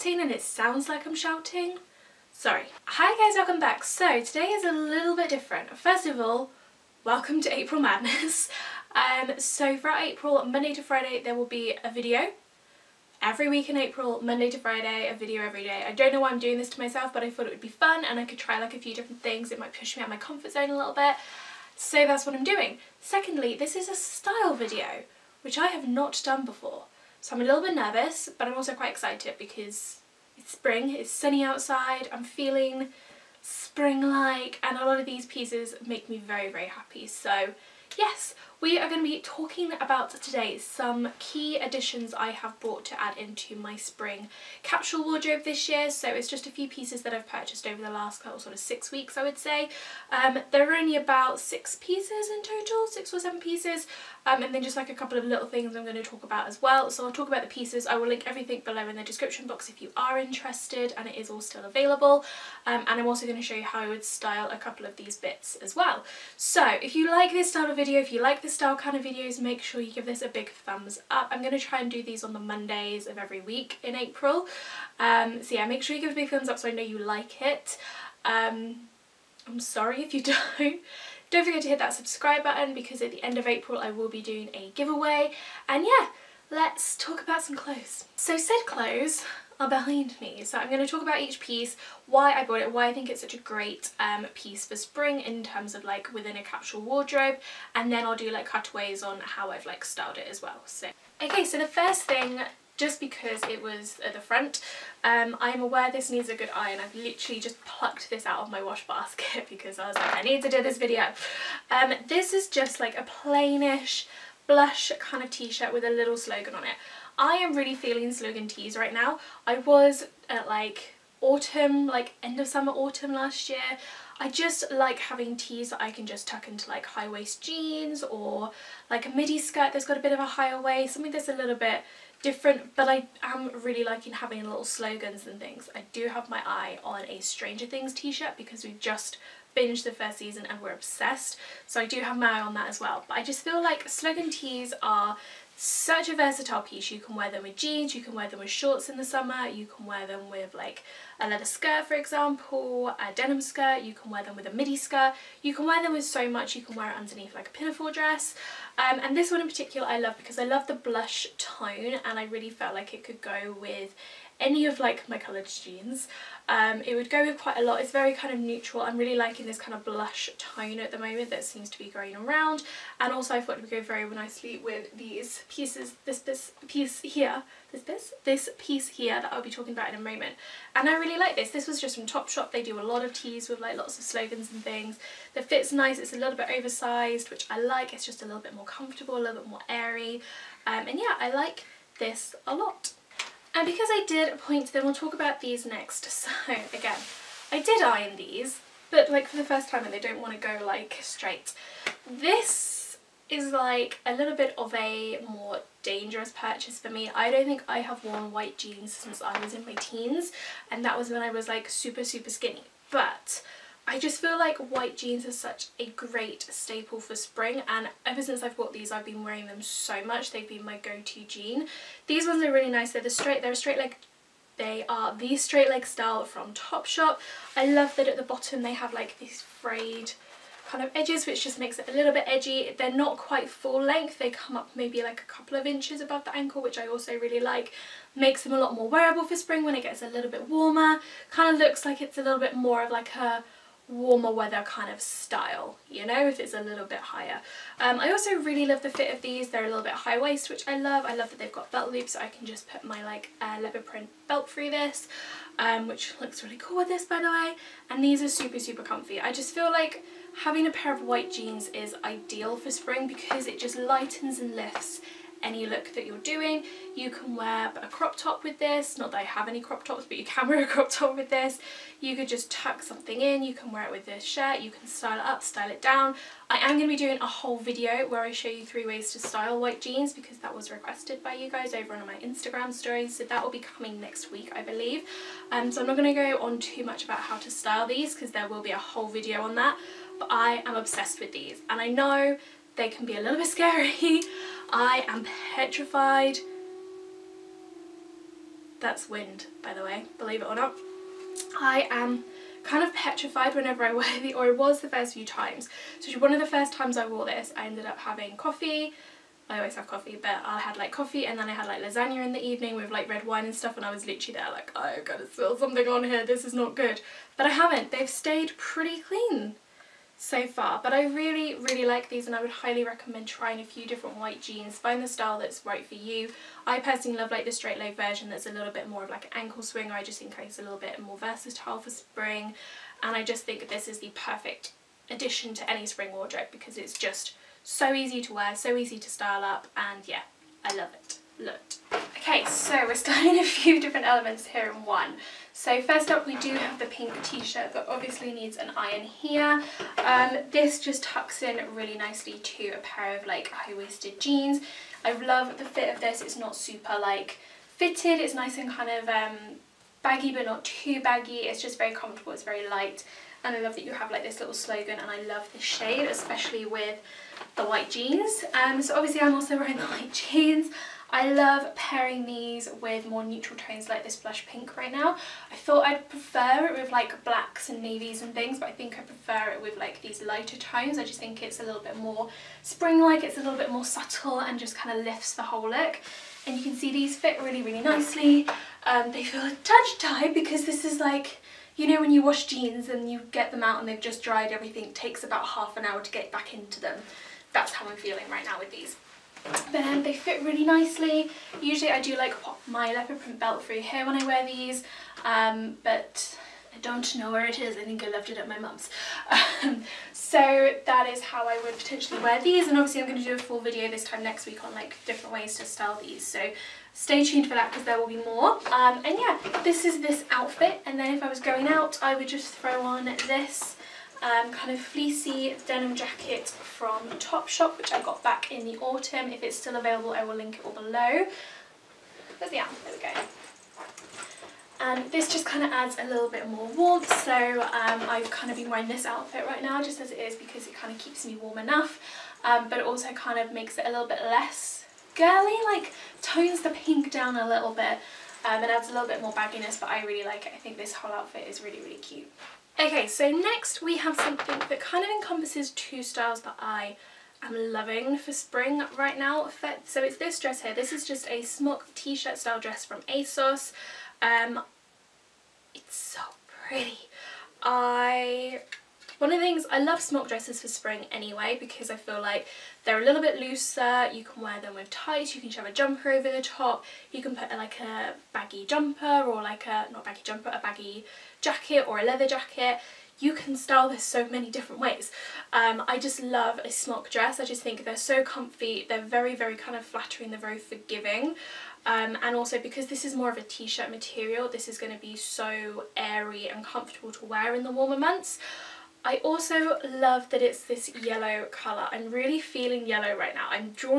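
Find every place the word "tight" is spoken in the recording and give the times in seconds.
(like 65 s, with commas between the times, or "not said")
389 s, 474 s.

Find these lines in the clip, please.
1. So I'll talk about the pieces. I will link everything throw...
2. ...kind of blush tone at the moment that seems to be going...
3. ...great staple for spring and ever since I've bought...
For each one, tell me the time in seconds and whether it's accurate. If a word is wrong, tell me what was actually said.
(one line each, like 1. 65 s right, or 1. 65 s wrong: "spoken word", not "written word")
1. 56 s wrong: "below", not "throw"
2. 169 s right
3. 215 s right.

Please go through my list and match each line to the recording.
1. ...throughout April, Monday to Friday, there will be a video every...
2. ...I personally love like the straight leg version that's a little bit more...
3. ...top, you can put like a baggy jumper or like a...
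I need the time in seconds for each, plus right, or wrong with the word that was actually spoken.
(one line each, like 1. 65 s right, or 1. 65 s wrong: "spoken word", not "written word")
1. 9 s right
2. 326 s right
3. 476 s right.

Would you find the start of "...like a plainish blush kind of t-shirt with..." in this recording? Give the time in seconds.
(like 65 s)
112 s.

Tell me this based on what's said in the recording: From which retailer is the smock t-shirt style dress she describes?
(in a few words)
ASOS.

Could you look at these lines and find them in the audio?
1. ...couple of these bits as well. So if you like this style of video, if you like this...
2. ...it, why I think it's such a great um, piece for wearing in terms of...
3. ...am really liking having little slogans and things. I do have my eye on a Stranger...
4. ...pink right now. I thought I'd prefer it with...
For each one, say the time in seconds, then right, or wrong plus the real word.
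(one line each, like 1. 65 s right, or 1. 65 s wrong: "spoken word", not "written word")
1. 64 s right
2. 92 s wrong: "spring", not "wearing"
3. 133 s right
4. 374 s right.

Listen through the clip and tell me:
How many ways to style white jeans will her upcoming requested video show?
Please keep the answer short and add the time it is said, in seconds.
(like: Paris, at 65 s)
3, at 278 s.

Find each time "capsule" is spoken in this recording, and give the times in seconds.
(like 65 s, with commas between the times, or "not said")
44 s, 96 s.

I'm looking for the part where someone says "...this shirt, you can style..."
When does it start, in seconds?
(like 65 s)
274 s.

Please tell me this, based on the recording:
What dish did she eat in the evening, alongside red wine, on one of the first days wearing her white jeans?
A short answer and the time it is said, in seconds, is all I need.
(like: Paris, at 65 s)
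Lasagna, at 311 s.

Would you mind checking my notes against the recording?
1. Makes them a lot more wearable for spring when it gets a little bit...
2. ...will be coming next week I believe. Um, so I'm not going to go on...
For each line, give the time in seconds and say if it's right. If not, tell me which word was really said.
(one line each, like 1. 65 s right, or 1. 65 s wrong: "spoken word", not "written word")
1. 238 s right
2. 283 s right.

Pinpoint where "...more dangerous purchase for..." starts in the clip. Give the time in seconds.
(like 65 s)
205 s.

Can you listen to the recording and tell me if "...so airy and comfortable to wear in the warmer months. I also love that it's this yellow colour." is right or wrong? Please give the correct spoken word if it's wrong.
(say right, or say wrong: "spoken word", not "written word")
right.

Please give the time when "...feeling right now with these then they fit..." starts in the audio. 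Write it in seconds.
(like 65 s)
397 s.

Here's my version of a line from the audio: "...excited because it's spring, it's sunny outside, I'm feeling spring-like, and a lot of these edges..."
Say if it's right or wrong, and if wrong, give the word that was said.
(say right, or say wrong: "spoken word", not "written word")
wrong: "pieces", not "edges".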